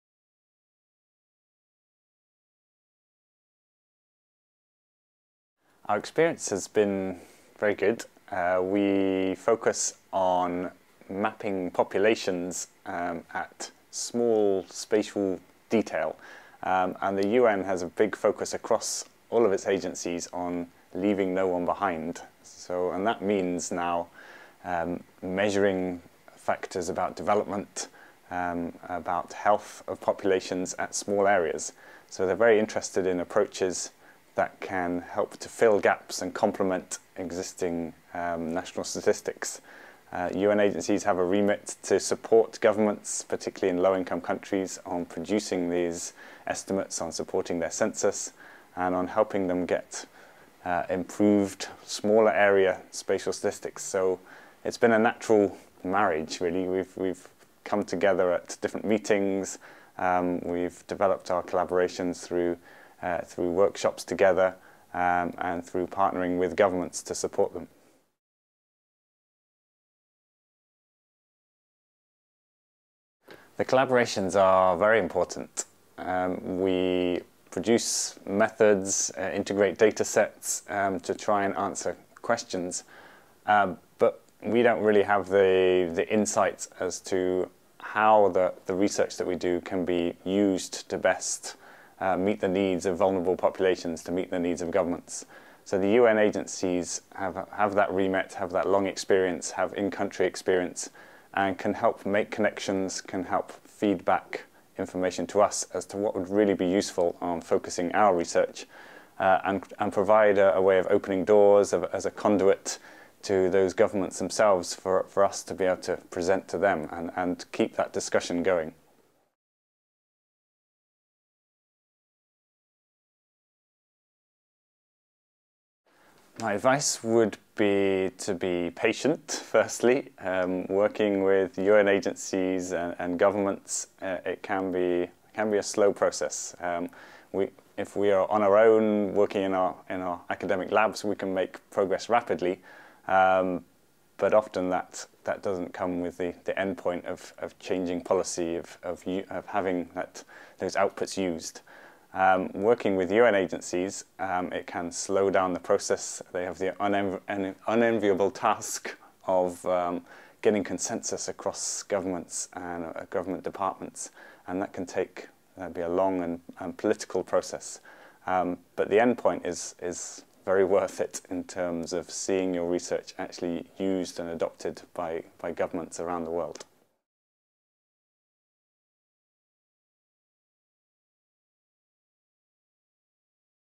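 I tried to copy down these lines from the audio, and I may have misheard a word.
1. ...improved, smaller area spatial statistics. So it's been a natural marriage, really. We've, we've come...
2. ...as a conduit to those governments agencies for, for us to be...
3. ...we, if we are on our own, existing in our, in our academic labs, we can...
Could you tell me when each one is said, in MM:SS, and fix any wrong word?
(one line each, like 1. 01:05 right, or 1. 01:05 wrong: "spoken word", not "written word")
1. 00:50 right
2. 01:51 wrong: "themselves", not "agencies"
3. 02:17 wrong: "working", not "existing".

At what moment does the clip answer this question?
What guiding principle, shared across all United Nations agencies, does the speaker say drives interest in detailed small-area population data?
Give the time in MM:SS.
00:20.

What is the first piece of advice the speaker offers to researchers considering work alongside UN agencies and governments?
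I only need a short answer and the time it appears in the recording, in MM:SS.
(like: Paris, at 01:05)
Be patient, at 02:08.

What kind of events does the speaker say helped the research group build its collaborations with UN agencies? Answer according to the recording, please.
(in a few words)
Workshops.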